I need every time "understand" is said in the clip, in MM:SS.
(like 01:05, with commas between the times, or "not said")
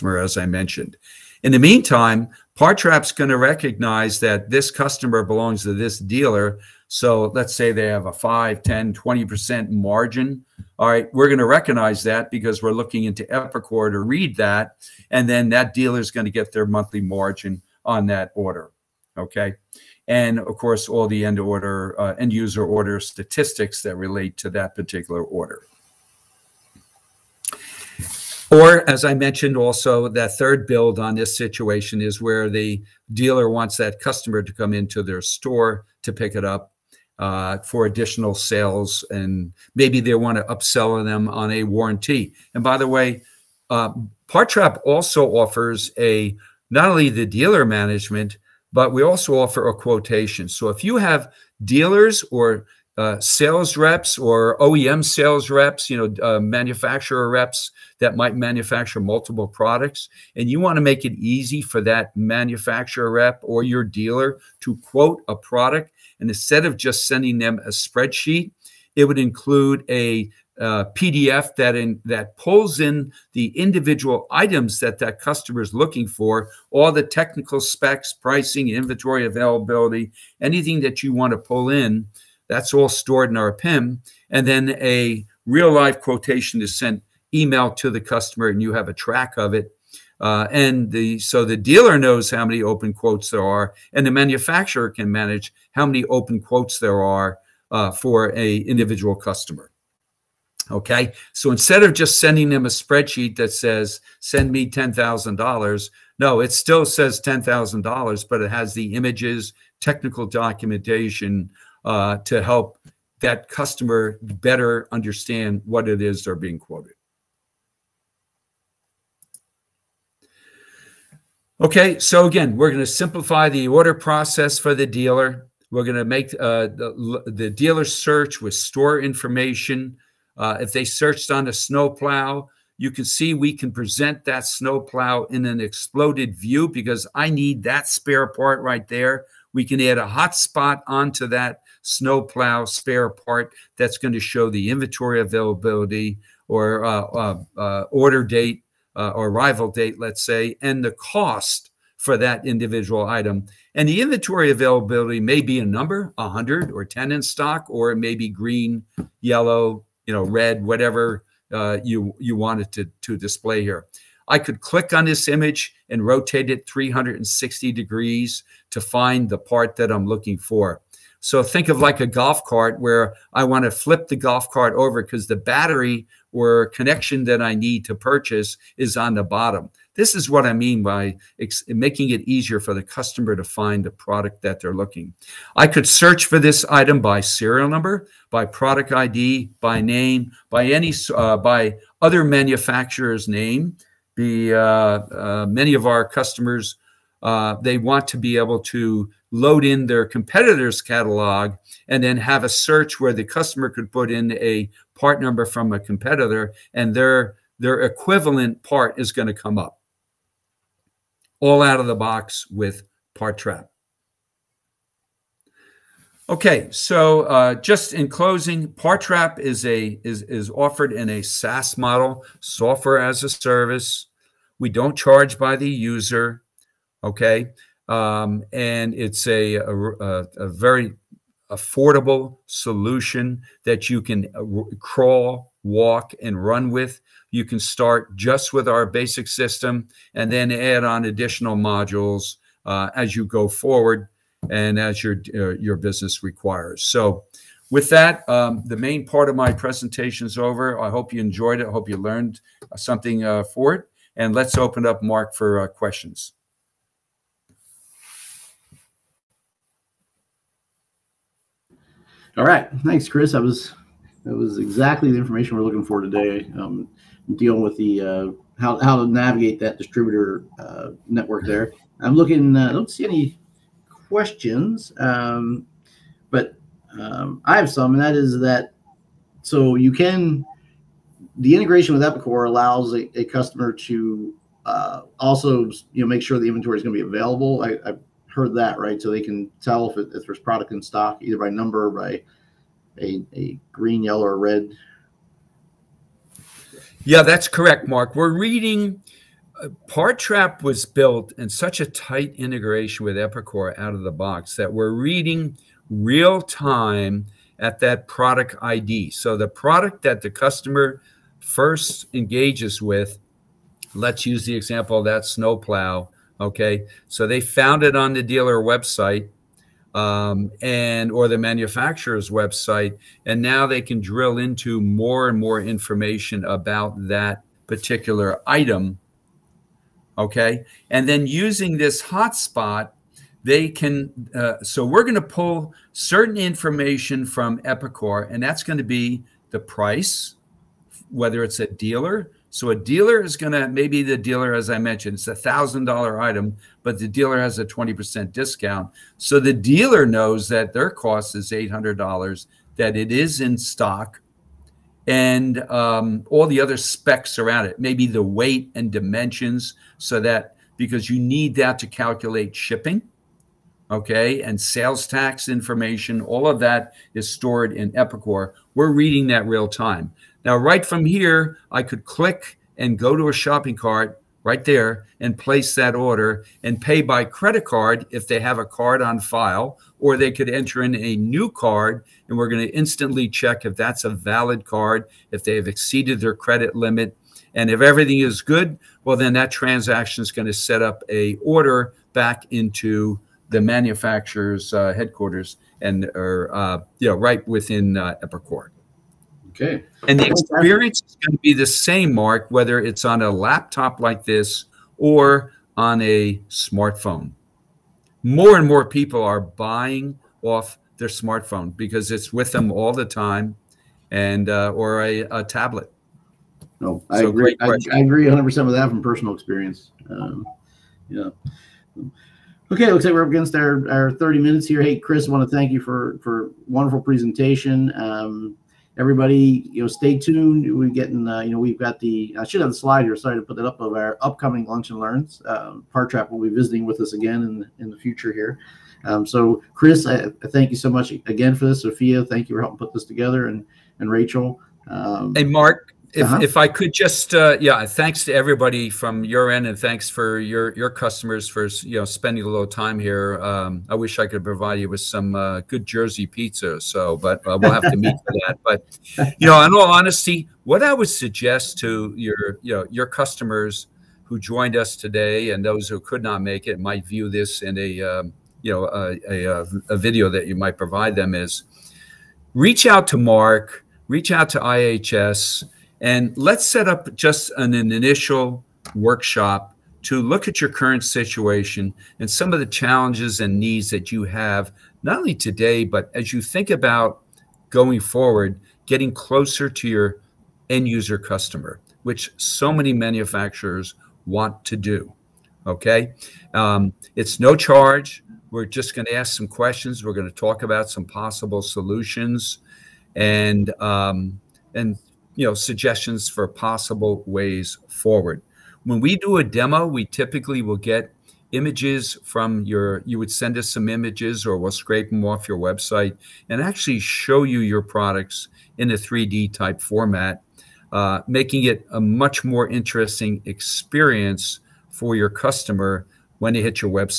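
01:54.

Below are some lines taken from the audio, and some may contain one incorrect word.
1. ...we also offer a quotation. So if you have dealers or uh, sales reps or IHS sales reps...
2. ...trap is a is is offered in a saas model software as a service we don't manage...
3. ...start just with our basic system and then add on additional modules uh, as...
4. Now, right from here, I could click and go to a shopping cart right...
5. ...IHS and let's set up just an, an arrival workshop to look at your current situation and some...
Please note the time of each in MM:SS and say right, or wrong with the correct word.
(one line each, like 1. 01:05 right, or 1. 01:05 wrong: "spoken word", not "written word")
1. 00:48 wrong: "OEM", not "IHS"
2. 03:39 wrong: "charge", not "manage"
3. 03:57 right
4. 06:10 right
5. 07:54 wrong: "initial", not "arrival".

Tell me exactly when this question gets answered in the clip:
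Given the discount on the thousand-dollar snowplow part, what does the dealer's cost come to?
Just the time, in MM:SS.
05:51.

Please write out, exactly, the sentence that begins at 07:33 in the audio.
Um, I wish I could provide you with some uh, good Jersey pizza, so but uh, we'll have to meet for that.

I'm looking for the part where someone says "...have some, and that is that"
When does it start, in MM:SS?
04:37.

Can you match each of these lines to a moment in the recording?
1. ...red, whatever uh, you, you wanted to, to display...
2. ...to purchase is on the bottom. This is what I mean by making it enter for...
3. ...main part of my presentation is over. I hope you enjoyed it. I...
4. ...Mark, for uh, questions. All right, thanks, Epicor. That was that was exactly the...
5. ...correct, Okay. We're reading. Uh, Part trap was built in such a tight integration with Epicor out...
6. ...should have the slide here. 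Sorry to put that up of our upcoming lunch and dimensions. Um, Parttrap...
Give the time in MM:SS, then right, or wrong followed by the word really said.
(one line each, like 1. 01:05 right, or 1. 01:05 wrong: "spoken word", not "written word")
1. 02:40 right
2. 02:57 wrong: "easier", not "enter"
3. 04:08 right
4. 04:15 wrong: "Chris", not "Epicor"
5. 04:57 wrong: "Mark", not "Okay"
6. 07:12 wrong: "learns", not "dimensions".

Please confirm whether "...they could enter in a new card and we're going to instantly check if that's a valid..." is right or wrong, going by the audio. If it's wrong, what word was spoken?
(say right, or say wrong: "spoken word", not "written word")
right.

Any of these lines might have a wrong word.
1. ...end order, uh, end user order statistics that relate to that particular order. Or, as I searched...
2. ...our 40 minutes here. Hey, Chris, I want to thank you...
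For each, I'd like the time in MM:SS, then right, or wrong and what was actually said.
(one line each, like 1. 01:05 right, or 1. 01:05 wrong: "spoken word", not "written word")
1. 00:21 wrong: "mentioned", not "searched"
2. 07:03 wrong: "30", not "40".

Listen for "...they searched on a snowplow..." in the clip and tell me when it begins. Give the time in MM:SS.
02:10.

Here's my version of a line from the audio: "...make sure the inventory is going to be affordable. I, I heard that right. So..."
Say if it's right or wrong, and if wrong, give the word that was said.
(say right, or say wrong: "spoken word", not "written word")
wrong: "available", not "affordable".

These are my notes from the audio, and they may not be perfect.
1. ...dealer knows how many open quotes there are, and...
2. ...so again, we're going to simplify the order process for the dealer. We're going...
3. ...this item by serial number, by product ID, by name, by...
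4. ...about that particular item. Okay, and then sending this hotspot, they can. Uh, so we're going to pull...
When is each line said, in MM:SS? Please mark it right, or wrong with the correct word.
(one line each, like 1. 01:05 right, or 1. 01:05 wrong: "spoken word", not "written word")
1. 01:31 right
2. 02:01 right
3. 03:06 right
4. 05:26 wrong: "using", not "sending".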